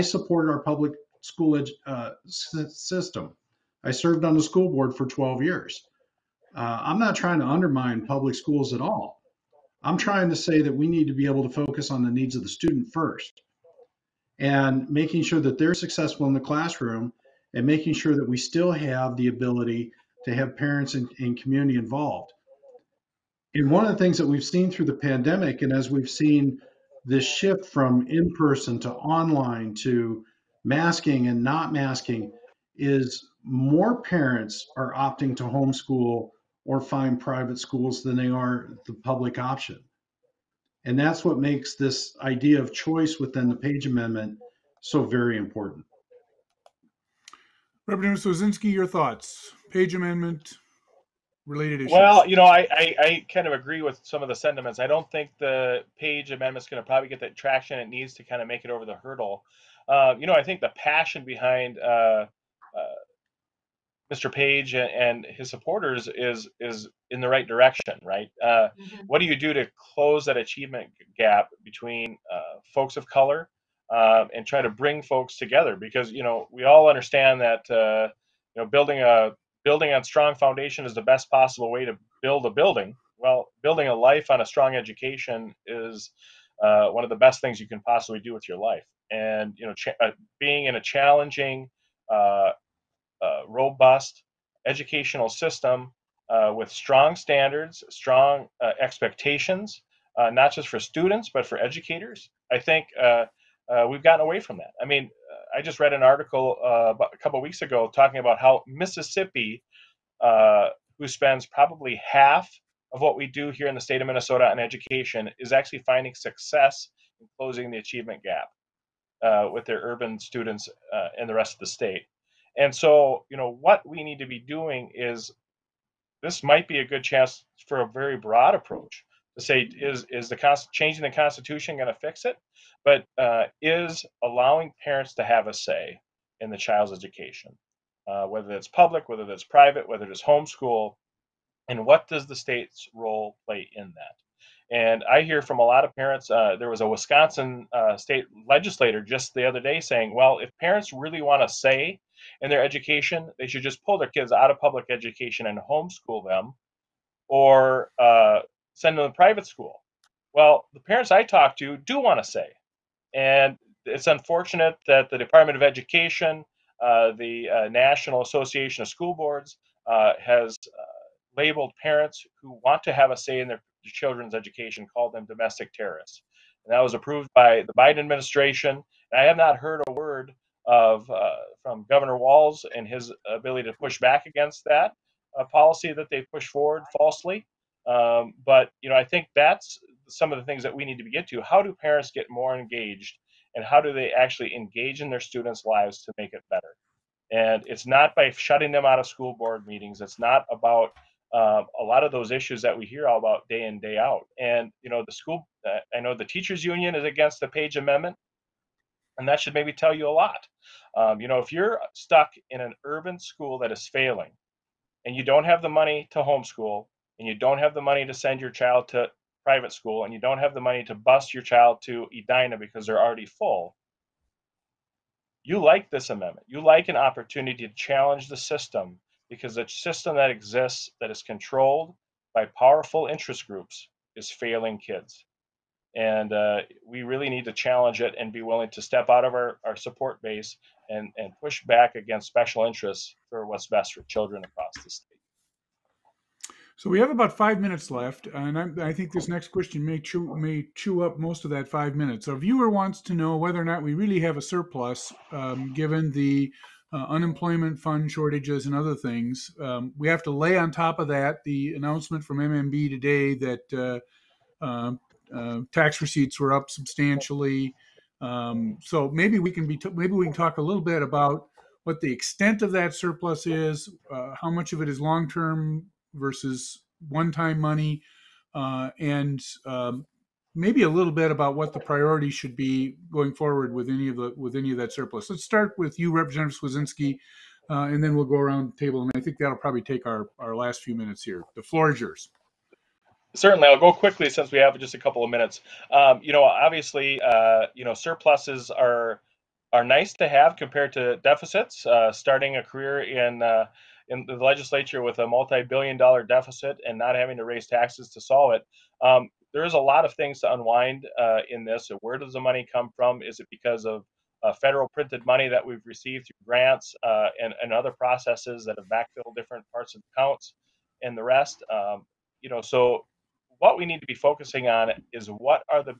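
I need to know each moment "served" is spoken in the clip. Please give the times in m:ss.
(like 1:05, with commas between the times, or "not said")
0:03.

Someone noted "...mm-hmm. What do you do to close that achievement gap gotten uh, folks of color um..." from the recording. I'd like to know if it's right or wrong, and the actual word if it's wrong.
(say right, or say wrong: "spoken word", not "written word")
wrong: "between", not "gotten".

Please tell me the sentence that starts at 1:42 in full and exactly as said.
I think uh, we've gotten away from that.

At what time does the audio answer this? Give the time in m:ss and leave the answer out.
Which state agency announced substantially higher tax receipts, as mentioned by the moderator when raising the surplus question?
4:22.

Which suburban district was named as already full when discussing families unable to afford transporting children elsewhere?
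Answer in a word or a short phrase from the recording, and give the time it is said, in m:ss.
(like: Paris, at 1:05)
Edina, at 3:42.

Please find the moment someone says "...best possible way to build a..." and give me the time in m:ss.
1:21.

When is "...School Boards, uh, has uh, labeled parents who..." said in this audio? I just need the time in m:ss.
2:48.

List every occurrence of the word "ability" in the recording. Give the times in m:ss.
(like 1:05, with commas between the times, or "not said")
0:19, 3:03.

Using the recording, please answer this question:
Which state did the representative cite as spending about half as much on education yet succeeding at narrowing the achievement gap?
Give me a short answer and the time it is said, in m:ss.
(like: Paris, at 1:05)
Mississippi, at 1:48.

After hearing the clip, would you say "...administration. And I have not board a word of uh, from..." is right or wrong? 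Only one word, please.
wrong.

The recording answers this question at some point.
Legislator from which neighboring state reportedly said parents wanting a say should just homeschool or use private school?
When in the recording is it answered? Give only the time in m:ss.
2:26.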